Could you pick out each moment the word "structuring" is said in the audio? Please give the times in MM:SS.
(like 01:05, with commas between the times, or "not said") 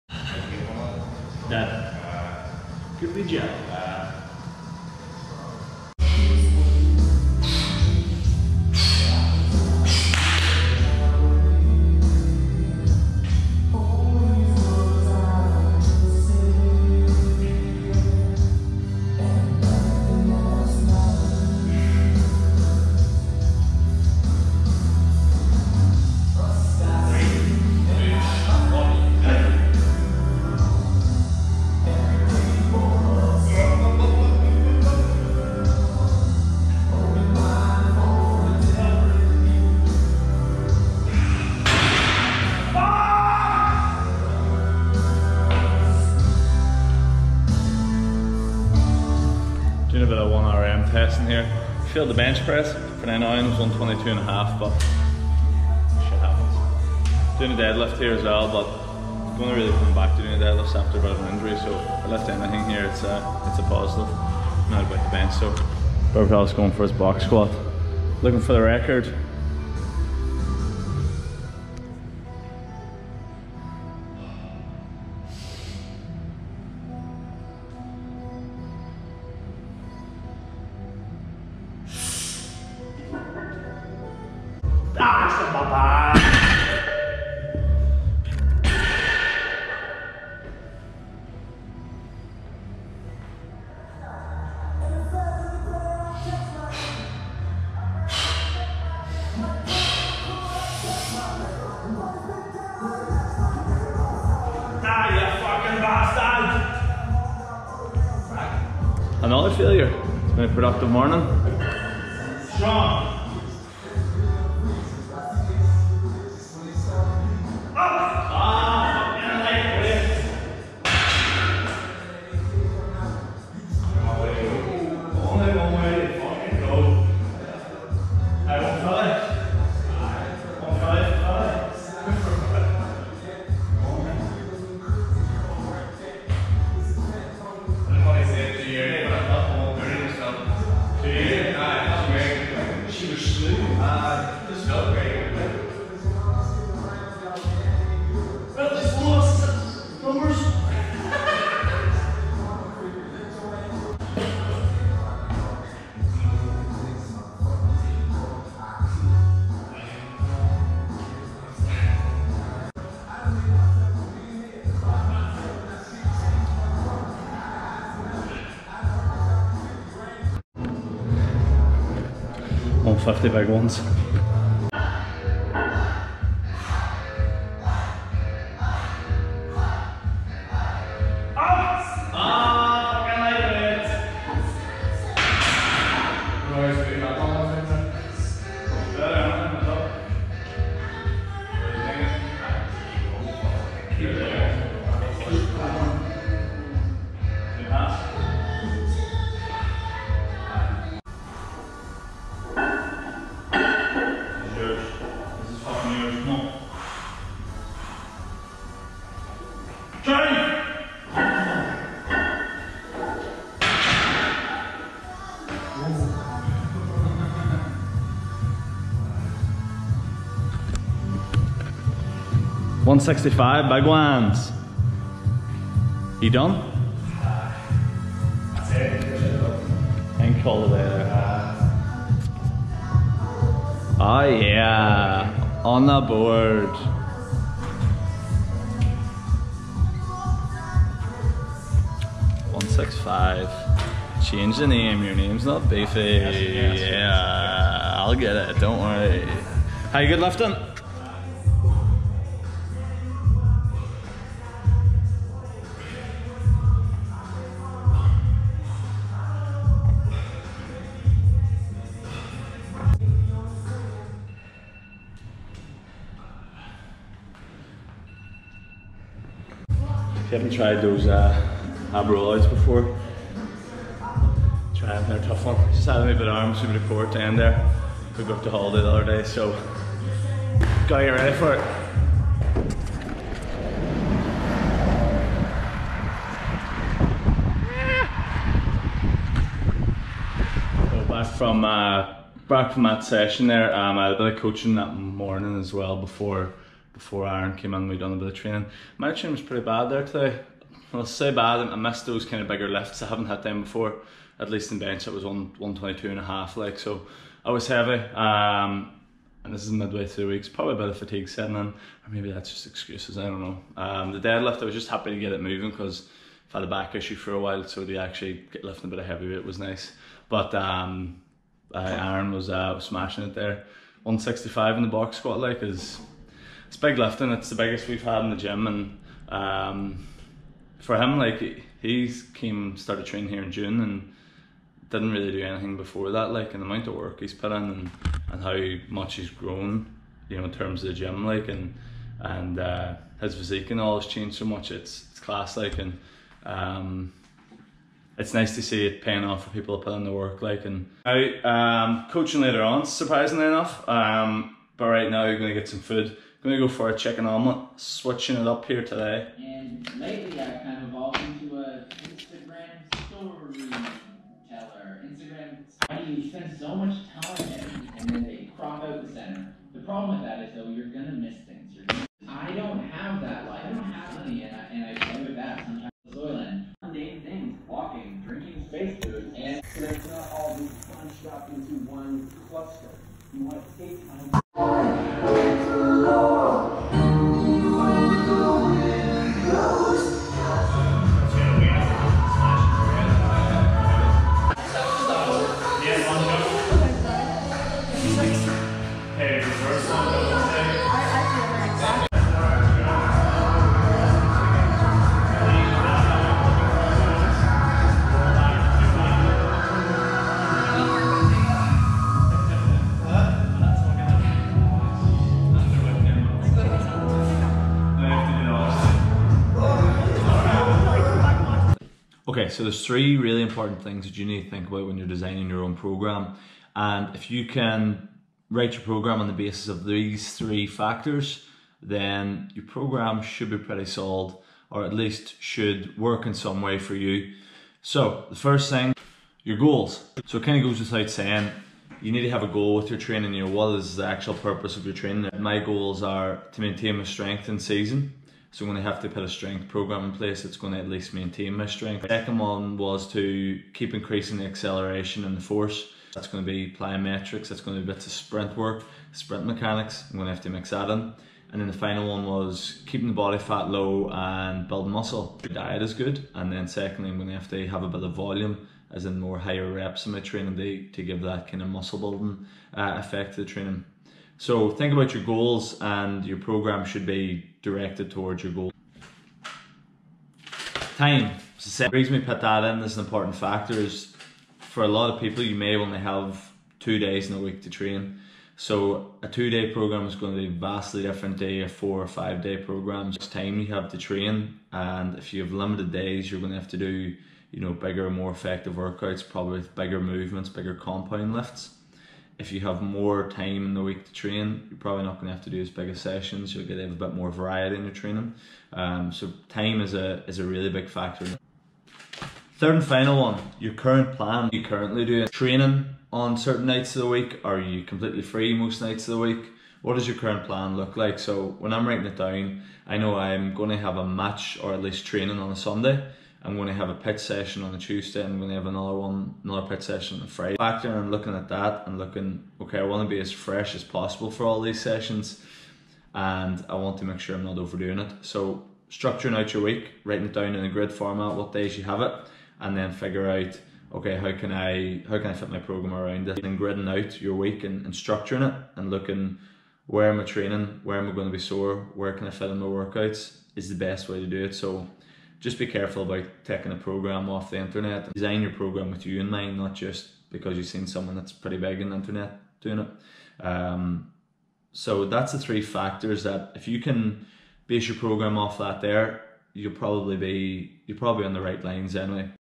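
08:58, 09:07.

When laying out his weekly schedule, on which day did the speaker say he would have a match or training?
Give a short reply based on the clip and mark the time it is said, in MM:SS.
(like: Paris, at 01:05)
Sunday, at 08:45.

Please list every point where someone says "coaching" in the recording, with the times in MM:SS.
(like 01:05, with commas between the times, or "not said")
04:54, 05:52.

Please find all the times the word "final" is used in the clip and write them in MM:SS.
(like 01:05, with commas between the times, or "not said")
07:41, 08:32.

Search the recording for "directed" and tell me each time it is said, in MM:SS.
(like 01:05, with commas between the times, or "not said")
07:57.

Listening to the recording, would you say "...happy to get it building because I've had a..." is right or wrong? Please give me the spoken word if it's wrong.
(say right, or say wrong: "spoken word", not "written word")
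wrong: "moving", not "building".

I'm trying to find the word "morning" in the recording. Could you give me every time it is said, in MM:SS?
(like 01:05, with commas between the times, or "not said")
01:50, 04:54.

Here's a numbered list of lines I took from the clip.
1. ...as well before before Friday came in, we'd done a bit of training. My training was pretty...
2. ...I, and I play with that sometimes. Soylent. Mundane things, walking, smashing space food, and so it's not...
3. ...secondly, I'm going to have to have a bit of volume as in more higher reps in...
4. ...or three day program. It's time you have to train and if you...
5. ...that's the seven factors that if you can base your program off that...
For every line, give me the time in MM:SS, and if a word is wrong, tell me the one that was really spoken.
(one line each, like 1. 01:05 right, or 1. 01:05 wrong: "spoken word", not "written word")
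1. 04:55 wrong: "Aaron", not "Friday"
2. 06:14 wrong: "drinking", not "smashing"
3. 07:46 right
4. 08:12 wrong: "five", not "three"
5. 09:25 wrong: "three", not "seven".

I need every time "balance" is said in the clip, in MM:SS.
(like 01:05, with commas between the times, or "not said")
not said.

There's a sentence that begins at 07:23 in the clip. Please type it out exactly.
You know, what is the actual purpose of your training?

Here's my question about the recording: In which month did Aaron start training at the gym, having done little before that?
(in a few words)
June.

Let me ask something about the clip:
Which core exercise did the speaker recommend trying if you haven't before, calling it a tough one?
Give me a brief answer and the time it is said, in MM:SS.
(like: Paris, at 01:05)
Ab rollouts, at 04:31.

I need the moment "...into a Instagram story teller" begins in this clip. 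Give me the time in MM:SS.
06:01.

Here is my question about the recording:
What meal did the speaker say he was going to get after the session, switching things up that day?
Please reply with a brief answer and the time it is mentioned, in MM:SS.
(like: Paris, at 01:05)
Chicken omelet, at 05:56.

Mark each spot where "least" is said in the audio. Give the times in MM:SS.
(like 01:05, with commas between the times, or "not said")
05:04, 07:14, 07:30, 08:44.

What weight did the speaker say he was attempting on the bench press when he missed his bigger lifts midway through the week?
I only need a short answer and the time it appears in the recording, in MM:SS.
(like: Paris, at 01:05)
122.5, at 05:05.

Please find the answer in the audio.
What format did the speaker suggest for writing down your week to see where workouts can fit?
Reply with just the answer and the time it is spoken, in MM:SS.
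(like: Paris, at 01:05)
Grid format, at 09:00.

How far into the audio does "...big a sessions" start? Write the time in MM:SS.
08:25.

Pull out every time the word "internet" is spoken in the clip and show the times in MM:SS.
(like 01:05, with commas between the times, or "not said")
09:17, 09:21.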